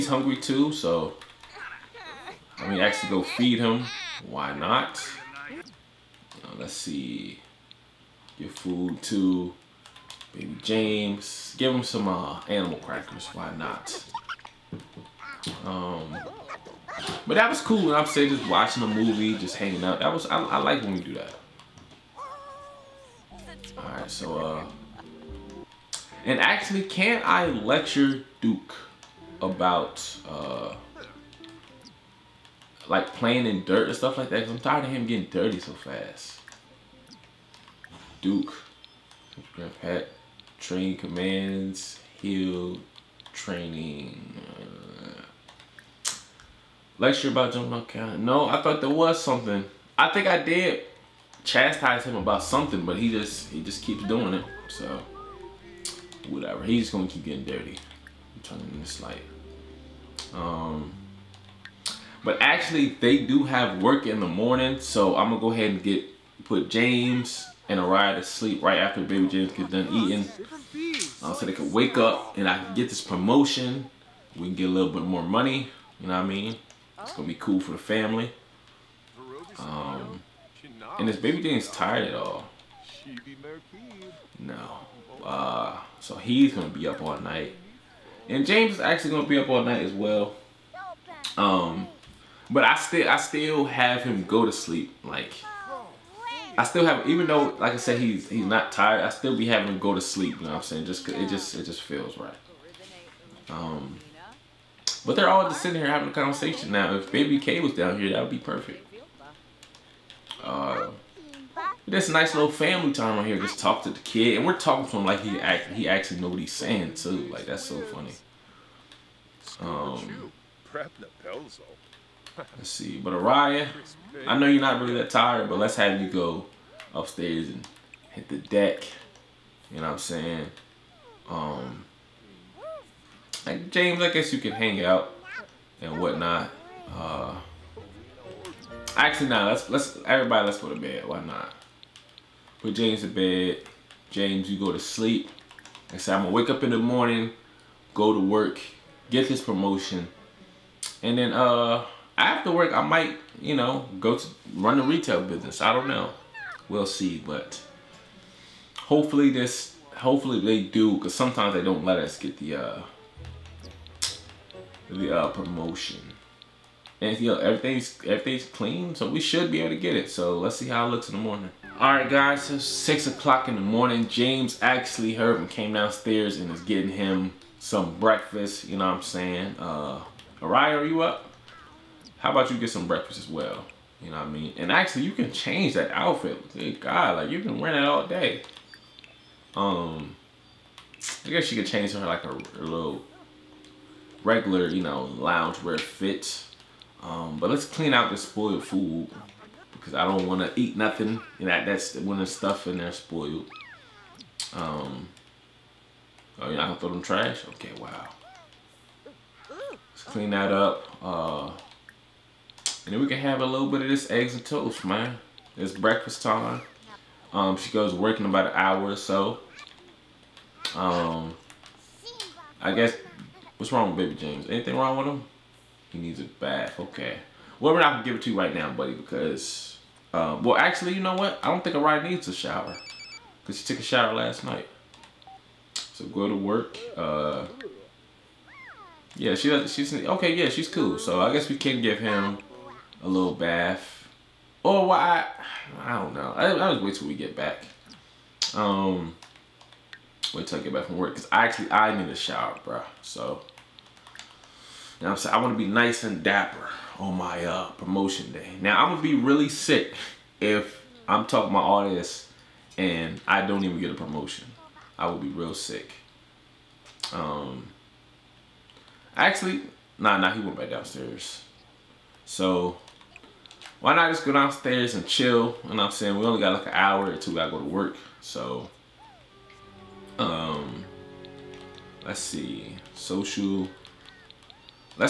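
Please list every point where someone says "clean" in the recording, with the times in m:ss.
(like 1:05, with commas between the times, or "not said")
2:48, 3:17, 3:30.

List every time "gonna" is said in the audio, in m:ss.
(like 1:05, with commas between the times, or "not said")
0:56, 1:05, 1:17, 3:26, 3:47.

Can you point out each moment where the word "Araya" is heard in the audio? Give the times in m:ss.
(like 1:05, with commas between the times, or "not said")
1:07, 2:03, 3:00, 3:51.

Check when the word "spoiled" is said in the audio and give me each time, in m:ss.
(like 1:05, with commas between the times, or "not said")
3:18, 3:22.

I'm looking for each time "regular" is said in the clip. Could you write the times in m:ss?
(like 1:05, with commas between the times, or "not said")
3:14.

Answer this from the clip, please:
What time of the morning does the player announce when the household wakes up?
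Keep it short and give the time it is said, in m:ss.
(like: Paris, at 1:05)
6 o'clock, at 2:52.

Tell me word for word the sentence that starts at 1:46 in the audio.
If baby K was down here, that would be perfect.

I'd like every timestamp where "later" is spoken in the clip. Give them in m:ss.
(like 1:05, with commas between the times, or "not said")
not said.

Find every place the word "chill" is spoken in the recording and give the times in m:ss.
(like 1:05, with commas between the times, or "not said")
4:35.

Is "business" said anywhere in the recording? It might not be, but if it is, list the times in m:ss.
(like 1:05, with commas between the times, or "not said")
2:35.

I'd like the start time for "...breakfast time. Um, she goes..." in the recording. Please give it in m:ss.
3:35.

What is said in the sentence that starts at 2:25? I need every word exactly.
I say, I'm going to wake up in the morning, go to work, get this promotion.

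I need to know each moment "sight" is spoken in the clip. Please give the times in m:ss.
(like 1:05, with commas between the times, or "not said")
not said.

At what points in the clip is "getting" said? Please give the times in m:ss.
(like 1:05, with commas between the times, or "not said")
0:35, 0:57, 2:56.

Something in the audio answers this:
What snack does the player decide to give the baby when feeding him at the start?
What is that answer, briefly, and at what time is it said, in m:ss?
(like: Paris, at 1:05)
Animal crackers, at 0:12.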